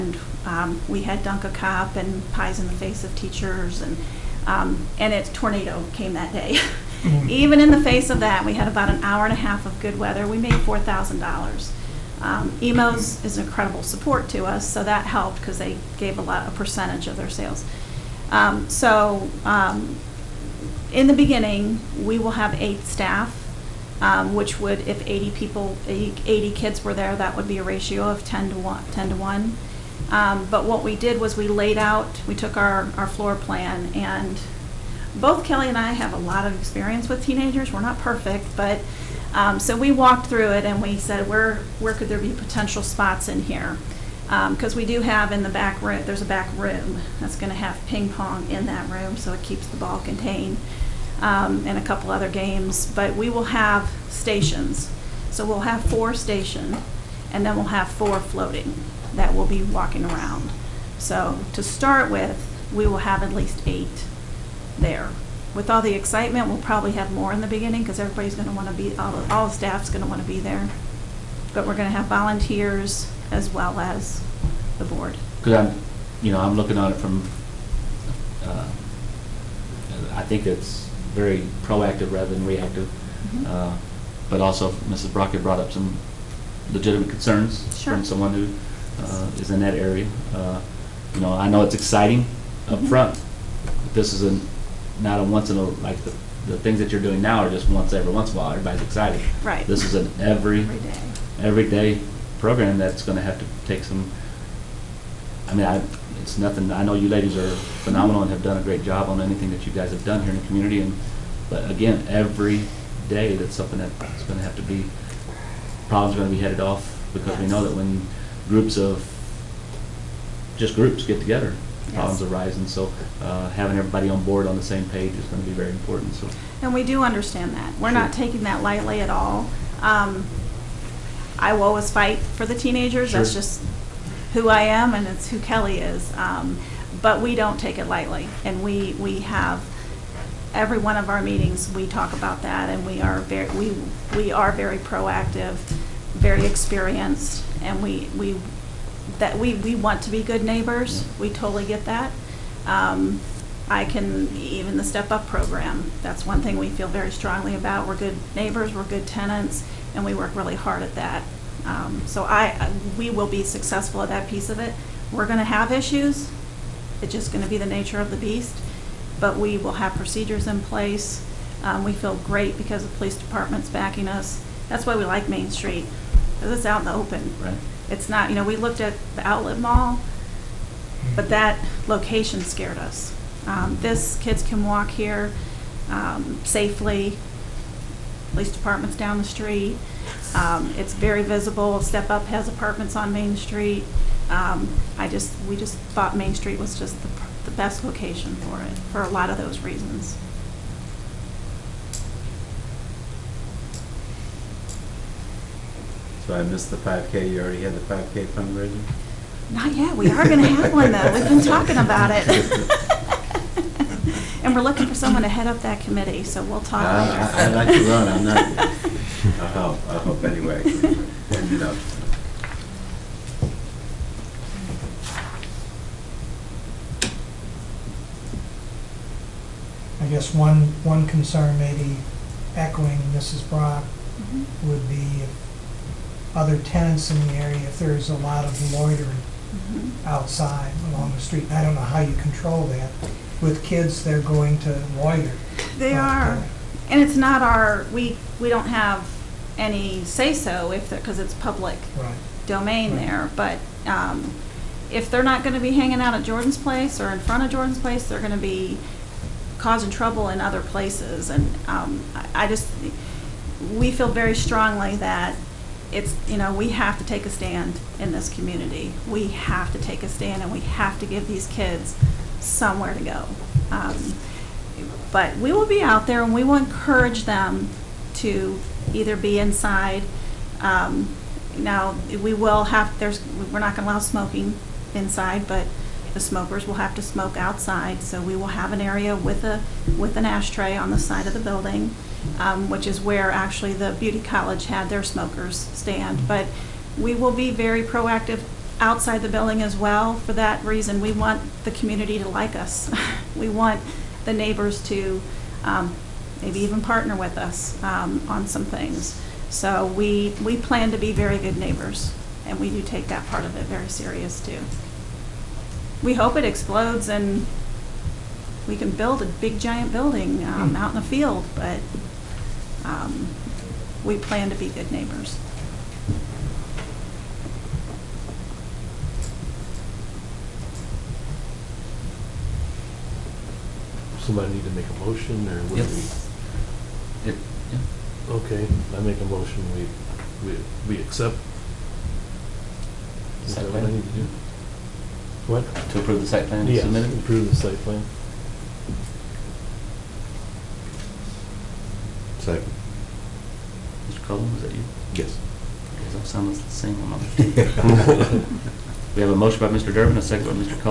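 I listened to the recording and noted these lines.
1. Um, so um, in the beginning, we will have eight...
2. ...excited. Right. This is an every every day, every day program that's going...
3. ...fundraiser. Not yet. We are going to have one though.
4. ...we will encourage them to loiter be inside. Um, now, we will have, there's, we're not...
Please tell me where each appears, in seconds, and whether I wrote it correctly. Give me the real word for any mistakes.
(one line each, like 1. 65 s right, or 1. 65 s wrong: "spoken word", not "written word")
1. 18 s right
2. 98 s right
3. 208 s right
4. 276 s wrong: "either", not "loiter".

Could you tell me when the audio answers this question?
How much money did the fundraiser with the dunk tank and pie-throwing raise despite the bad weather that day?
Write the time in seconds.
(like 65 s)
10 s.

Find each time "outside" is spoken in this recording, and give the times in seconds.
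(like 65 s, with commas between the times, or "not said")
240 s, 287 s, 298 s.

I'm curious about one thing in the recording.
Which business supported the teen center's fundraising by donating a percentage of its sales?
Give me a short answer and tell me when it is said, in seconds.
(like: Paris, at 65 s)
Emo's, at 12 s.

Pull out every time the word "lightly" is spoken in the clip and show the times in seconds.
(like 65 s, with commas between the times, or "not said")
128 s, 137 s.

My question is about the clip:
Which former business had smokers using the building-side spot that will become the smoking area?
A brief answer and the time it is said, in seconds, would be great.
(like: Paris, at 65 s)
The beauty college, at 293 s.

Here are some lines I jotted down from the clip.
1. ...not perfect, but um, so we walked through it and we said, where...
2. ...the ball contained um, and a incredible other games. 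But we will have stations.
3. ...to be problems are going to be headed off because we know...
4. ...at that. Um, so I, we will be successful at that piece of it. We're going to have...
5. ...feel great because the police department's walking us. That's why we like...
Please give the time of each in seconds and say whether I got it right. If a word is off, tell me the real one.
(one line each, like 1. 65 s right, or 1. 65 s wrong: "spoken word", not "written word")
1. 37 s right
2. 49 s wrong: "couple", not "incredible"
3. 114 s right
4. 160 s right
5. 171 s wrong: "backing", not "walking".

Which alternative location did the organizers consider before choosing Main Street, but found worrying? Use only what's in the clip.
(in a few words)
The outlet mall.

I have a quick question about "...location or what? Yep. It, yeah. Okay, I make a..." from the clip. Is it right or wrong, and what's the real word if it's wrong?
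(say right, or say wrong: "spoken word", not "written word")
wrong: "motion", not "location".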